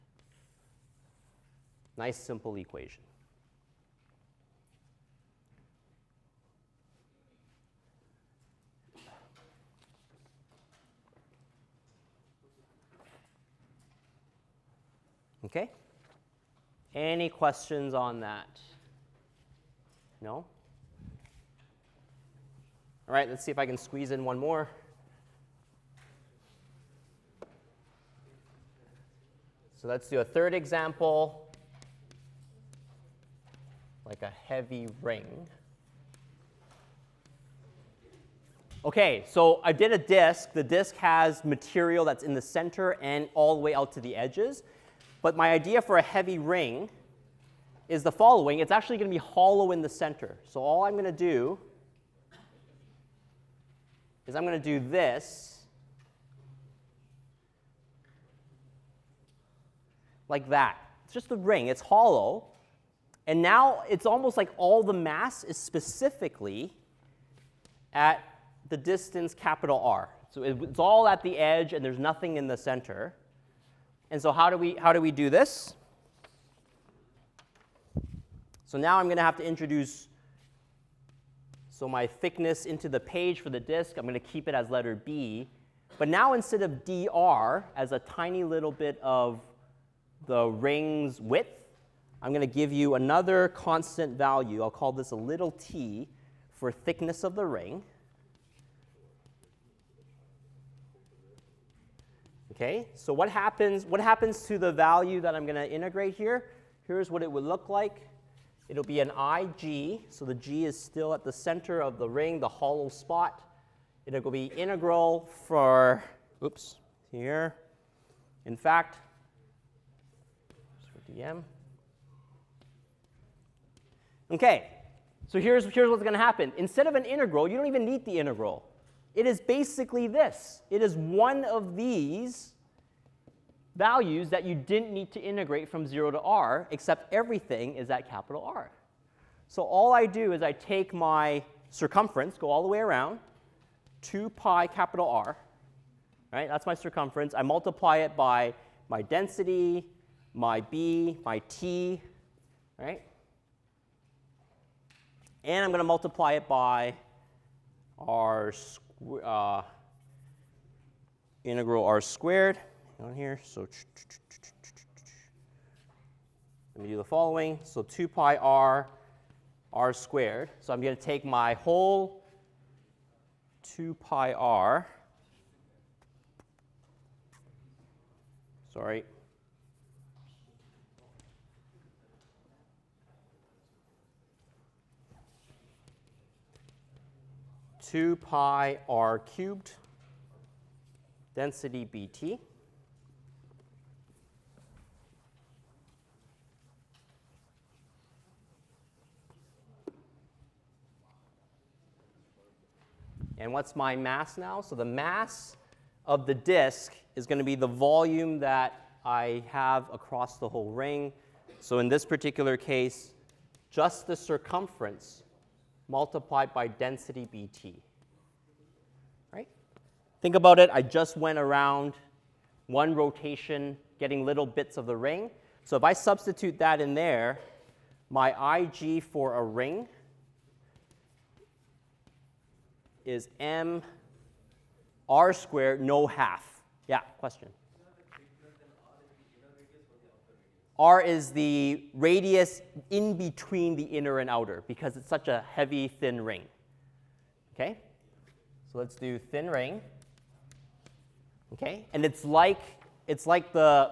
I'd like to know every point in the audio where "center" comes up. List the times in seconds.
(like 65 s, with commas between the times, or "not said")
42 s, 49 s, 72 s, 111 s.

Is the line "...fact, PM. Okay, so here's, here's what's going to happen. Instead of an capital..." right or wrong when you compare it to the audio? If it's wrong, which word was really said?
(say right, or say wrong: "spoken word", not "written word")
wrong: "integral", not "capital".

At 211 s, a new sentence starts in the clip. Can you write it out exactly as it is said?
So in this particular case, just the circumference multiplied by density bt.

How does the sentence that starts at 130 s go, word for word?
It is one of these values that you didn't need to integrate from 0 to r, except everything is at capital R.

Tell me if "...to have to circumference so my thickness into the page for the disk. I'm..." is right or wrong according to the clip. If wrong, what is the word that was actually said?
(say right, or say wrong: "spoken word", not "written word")
wrong: "introduce", not "circumference".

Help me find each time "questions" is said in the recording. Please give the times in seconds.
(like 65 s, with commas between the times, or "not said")
17 s, 237 s.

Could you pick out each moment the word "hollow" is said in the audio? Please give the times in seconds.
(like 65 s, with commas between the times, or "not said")
49 s, 61 s, 112 s.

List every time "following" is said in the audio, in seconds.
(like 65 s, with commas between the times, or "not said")
48 s, 167 s.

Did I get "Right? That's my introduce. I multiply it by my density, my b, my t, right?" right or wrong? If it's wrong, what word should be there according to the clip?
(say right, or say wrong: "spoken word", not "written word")
wrong: "circumference", not "introduce".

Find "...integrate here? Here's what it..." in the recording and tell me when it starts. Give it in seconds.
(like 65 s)
105 s.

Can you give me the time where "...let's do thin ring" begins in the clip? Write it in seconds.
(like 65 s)
248 s.